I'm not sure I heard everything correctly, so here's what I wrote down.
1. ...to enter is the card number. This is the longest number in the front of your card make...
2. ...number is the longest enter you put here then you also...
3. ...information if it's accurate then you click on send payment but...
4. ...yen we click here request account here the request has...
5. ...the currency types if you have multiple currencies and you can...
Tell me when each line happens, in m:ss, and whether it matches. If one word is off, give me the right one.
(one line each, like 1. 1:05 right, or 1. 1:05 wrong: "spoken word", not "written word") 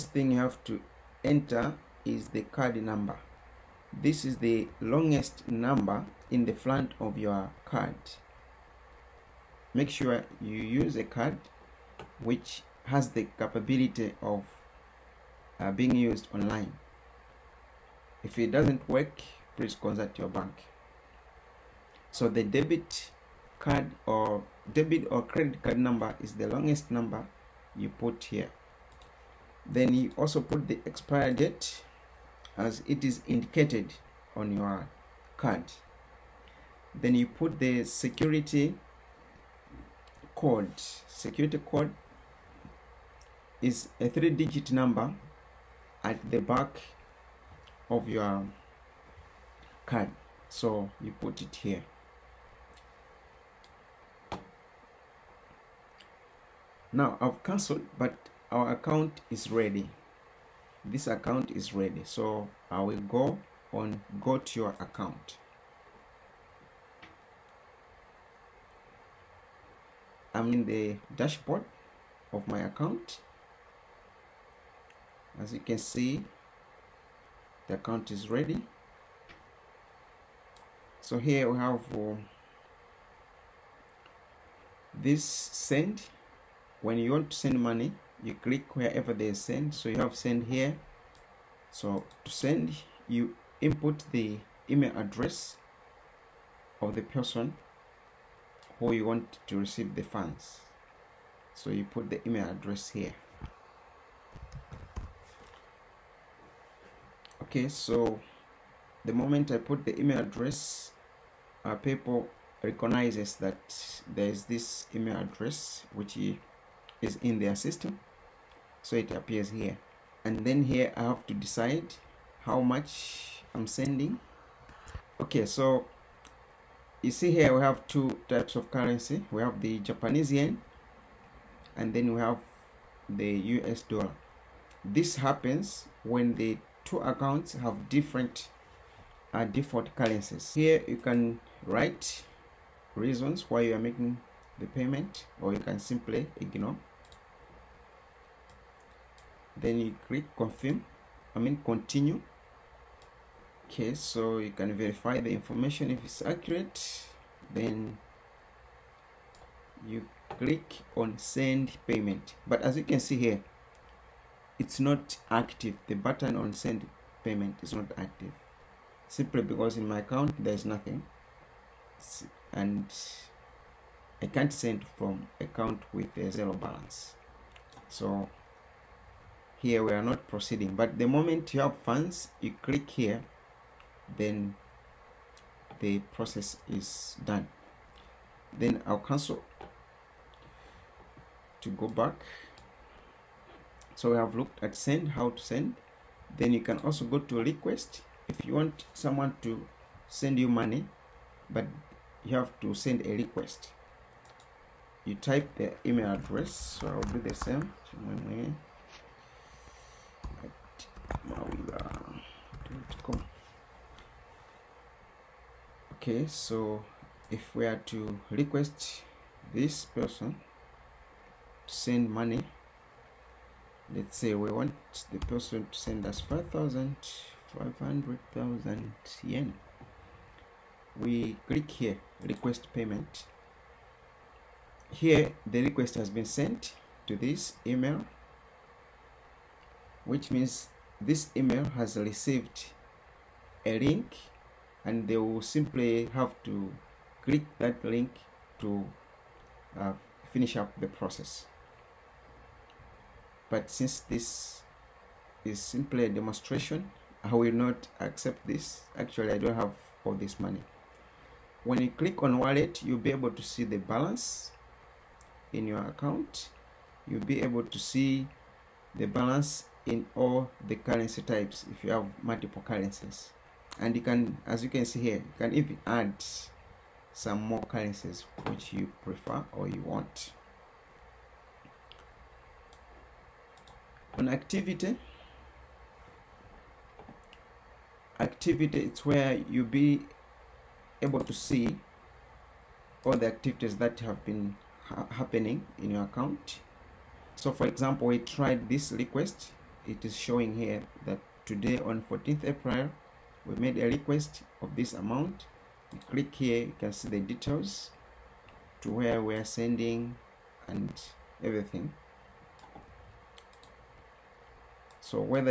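1. 0:00 right
2. 0:25 wrong: "number", not "enter"
3. 2:35 right
4. 3:49 wrong: "payment", not "account"
5. 4:30 right.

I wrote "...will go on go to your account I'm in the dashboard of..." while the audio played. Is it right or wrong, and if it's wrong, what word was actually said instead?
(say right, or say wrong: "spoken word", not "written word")
right.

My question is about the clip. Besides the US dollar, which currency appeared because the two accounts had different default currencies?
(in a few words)
Japanese yen.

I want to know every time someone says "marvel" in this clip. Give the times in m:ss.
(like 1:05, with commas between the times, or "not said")
not said.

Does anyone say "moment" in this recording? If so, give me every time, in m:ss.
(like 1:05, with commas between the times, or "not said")
1:49, 3:01.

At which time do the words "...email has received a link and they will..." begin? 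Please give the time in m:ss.
4:01.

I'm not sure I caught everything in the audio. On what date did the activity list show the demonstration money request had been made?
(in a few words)
14 April.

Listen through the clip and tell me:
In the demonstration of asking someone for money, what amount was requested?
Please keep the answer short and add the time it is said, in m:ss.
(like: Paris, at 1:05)
5500 yen, at 3:46.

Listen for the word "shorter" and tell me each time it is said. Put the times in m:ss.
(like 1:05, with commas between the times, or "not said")
not said.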